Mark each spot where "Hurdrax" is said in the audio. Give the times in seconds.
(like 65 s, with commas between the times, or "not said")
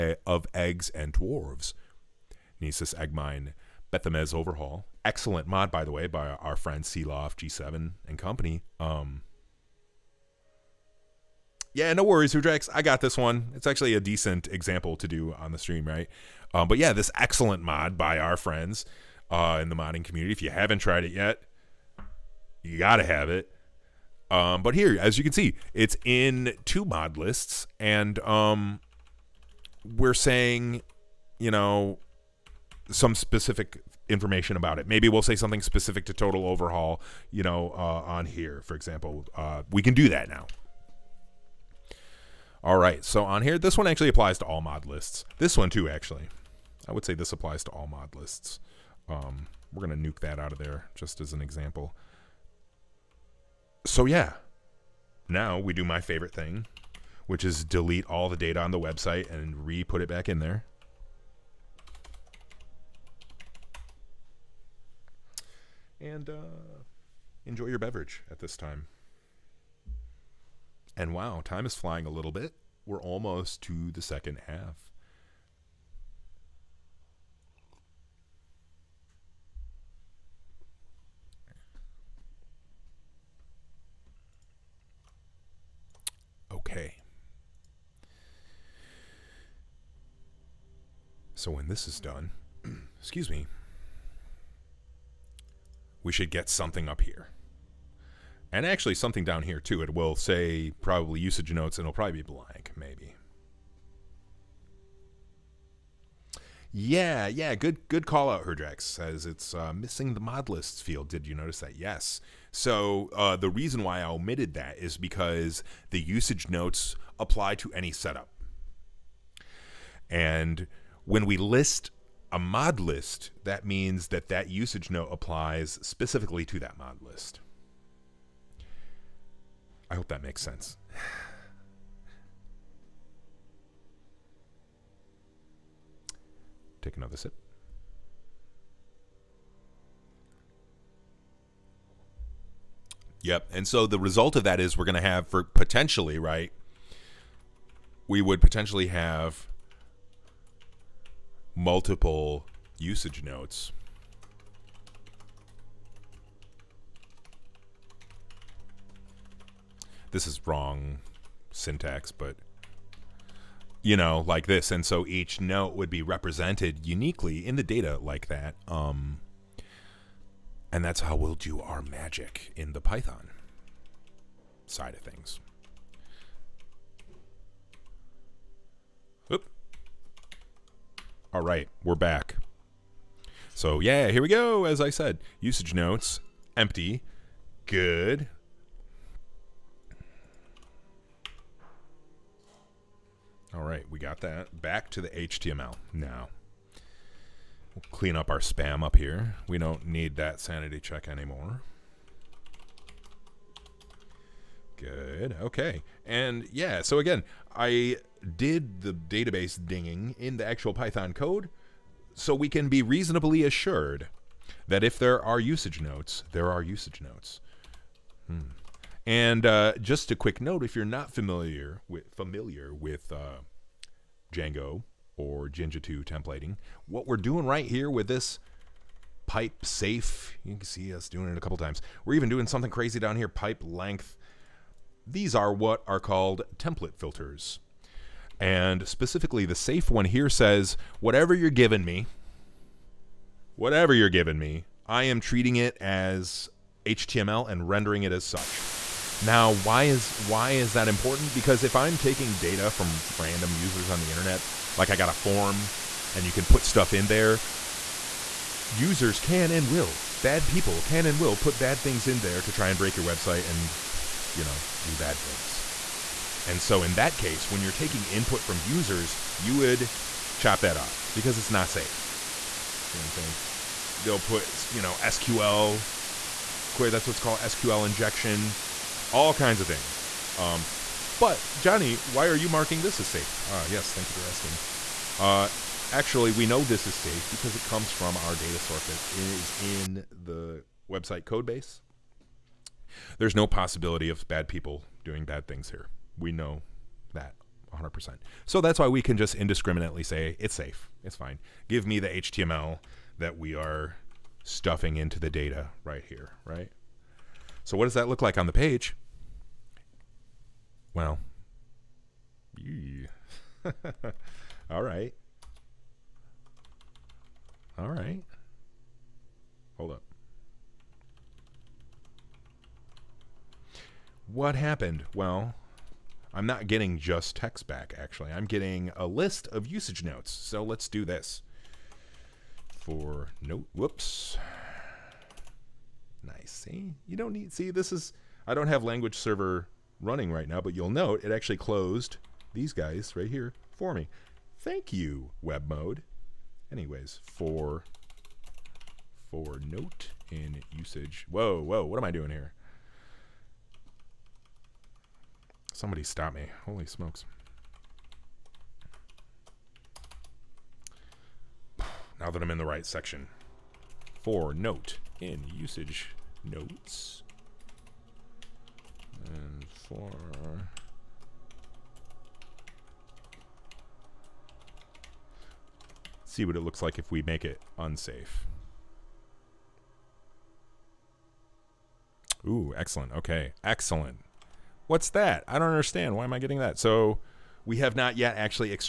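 12 s, 108 s.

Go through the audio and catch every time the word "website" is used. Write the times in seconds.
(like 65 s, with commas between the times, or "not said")
58 s, 263 s, 290 s.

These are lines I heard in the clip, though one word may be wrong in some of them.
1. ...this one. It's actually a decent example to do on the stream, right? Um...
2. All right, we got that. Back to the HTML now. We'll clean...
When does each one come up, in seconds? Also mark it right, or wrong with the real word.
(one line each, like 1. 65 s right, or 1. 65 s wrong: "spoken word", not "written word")
1. 13 s right
2. 193 s right.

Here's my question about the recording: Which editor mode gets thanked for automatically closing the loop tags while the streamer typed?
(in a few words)
web mode.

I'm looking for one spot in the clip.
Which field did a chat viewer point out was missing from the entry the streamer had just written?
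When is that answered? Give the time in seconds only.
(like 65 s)
110 s.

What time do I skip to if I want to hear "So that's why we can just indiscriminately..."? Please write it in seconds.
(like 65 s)
298 s.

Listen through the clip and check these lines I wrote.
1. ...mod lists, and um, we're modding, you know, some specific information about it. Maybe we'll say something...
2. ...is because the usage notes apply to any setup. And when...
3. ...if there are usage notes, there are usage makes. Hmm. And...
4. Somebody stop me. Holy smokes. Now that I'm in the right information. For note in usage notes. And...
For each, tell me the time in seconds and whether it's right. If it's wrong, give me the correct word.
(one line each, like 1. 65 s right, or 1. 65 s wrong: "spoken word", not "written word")
1. 26 s wrong: "saying", not "modding"
2. 114 s right
3. 214 s wrong: "notes", not "makes"
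4. 355 s wrong: "section", not "information".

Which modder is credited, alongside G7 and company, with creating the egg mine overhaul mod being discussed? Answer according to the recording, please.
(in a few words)
Sealoft.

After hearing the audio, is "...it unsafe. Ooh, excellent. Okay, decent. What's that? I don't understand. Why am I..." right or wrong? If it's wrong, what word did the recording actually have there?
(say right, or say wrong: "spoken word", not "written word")
wrong: "excellent", not "decent".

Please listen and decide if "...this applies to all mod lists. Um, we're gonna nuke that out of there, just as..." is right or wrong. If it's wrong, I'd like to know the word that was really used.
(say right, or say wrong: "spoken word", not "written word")
right.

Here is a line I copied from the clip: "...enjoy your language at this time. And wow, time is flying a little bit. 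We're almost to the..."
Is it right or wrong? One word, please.
wrong.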